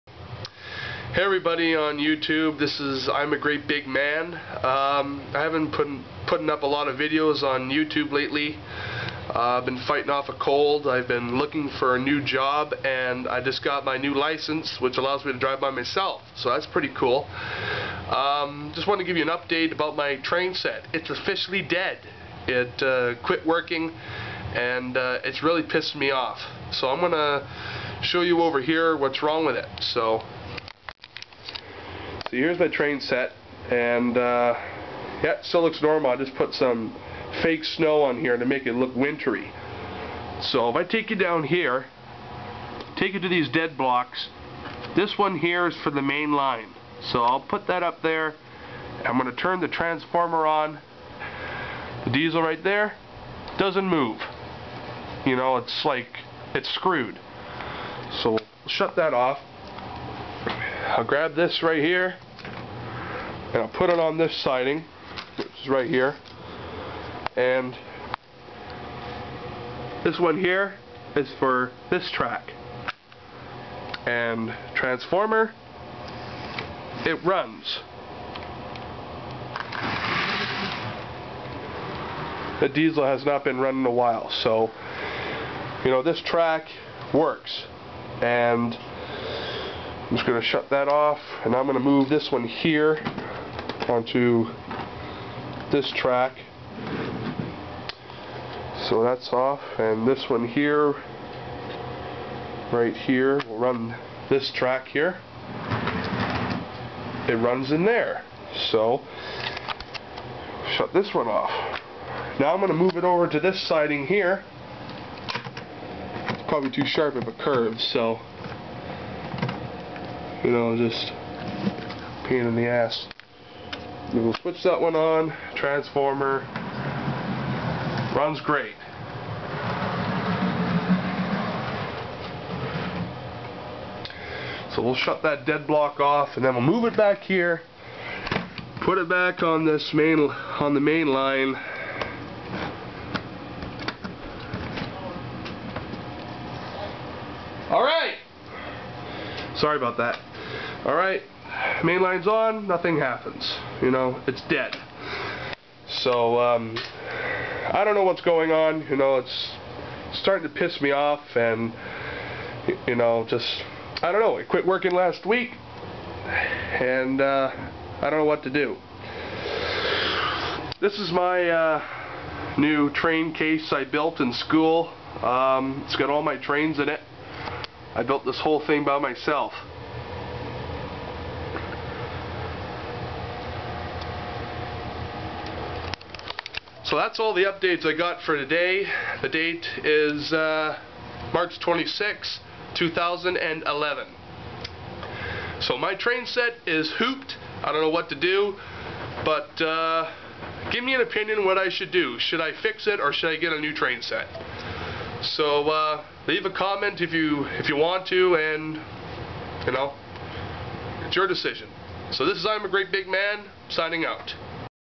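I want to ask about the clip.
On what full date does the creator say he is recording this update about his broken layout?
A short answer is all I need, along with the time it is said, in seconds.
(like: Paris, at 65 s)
March 26, 2011, at 191 s.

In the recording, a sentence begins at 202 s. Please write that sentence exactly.
Should I fix it or should I get a new train set?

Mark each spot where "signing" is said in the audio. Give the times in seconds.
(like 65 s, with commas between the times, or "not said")
213 s.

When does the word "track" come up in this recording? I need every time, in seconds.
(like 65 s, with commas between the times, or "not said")
72 s, 86 s, 95 s, 104 s.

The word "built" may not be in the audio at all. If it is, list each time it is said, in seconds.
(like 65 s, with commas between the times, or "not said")
173 s, 178 s.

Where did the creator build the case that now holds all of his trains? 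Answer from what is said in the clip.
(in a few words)
in school.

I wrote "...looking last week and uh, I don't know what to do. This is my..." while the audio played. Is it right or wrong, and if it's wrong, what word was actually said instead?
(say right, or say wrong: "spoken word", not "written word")
wrong: "working", not "looking".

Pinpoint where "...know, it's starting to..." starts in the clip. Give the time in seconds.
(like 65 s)
158 s.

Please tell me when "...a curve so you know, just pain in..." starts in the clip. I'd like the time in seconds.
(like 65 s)
117 s.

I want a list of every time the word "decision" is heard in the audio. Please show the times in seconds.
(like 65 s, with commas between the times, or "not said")
211 s.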